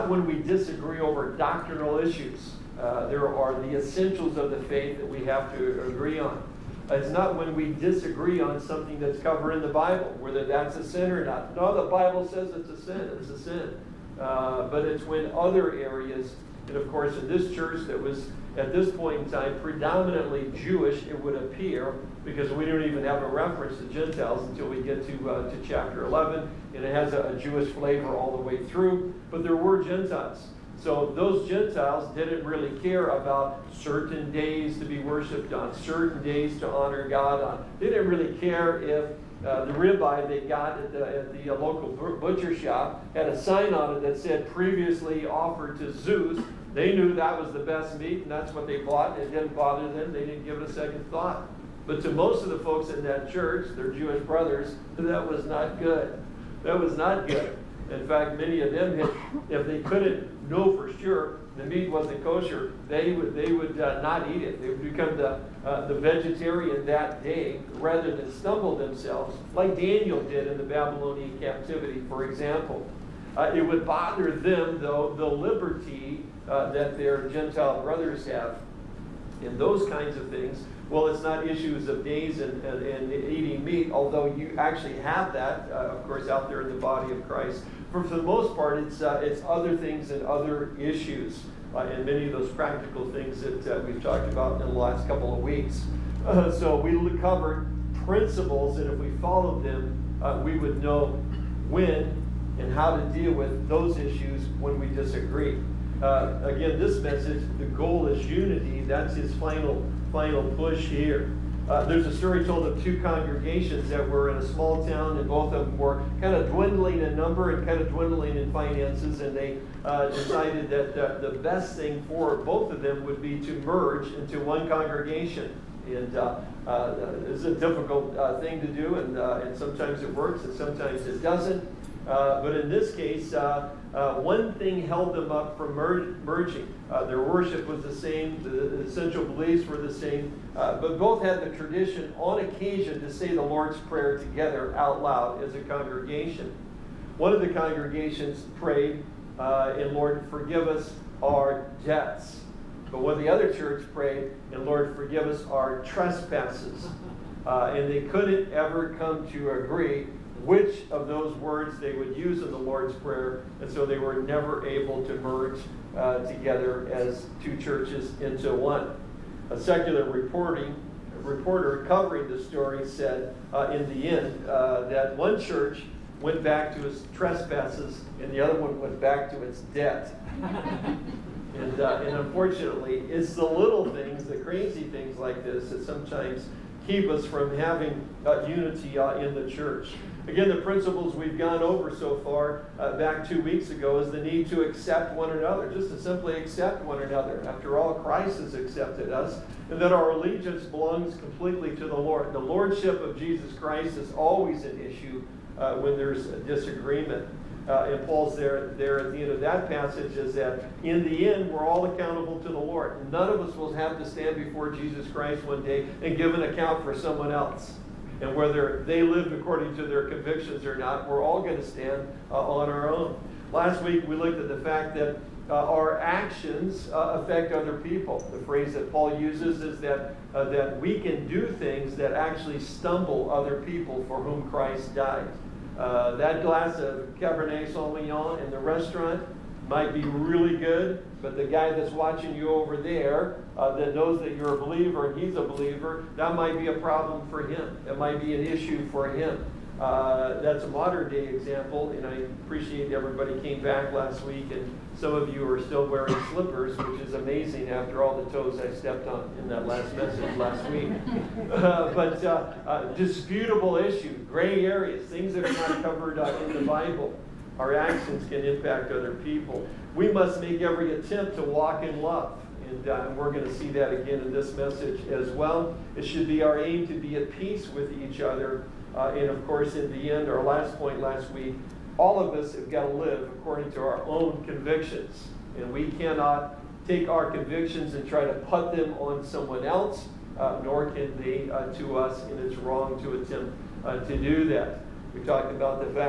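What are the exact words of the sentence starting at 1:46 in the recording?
Uh, again, this message, the goal is unity.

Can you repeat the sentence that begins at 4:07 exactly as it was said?
It might be an issue for him.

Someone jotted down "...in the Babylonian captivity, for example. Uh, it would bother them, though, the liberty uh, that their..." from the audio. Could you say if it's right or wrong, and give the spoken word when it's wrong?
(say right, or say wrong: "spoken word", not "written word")
right.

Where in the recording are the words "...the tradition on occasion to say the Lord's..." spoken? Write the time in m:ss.
2:21.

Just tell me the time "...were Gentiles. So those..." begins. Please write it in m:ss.
0:29.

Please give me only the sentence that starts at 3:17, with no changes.
After all, Christ has accepted us, and that our allegiance belongs completely to the Lord.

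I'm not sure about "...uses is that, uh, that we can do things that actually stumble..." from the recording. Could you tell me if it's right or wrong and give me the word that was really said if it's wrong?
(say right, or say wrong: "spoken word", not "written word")
right.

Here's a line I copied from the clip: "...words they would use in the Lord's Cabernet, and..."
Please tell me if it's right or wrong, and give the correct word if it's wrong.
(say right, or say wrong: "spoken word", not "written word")
wrong: "Prayer", not "Cabernet".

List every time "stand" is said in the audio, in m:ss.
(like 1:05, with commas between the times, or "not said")
3:34, 3:41.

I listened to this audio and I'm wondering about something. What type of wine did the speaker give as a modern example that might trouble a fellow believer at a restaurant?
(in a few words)
Cabernet Sauvignon.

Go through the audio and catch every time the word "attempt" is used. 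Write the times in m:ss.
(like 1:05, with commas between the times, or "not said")
4:30, 4:53.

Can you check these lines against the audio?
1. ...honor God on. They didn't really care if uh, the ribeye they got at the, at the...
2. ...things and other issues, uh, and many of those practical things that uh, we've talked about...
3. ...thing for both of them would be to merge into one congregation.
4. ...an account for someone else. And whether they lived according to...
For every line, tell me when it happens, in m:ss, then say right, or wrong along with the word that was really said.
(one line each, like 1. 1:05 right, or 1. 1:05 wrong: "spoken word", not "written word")
1. 0:36 right
2. 1:29 right
3. 2:01 right
4. 3:36 right.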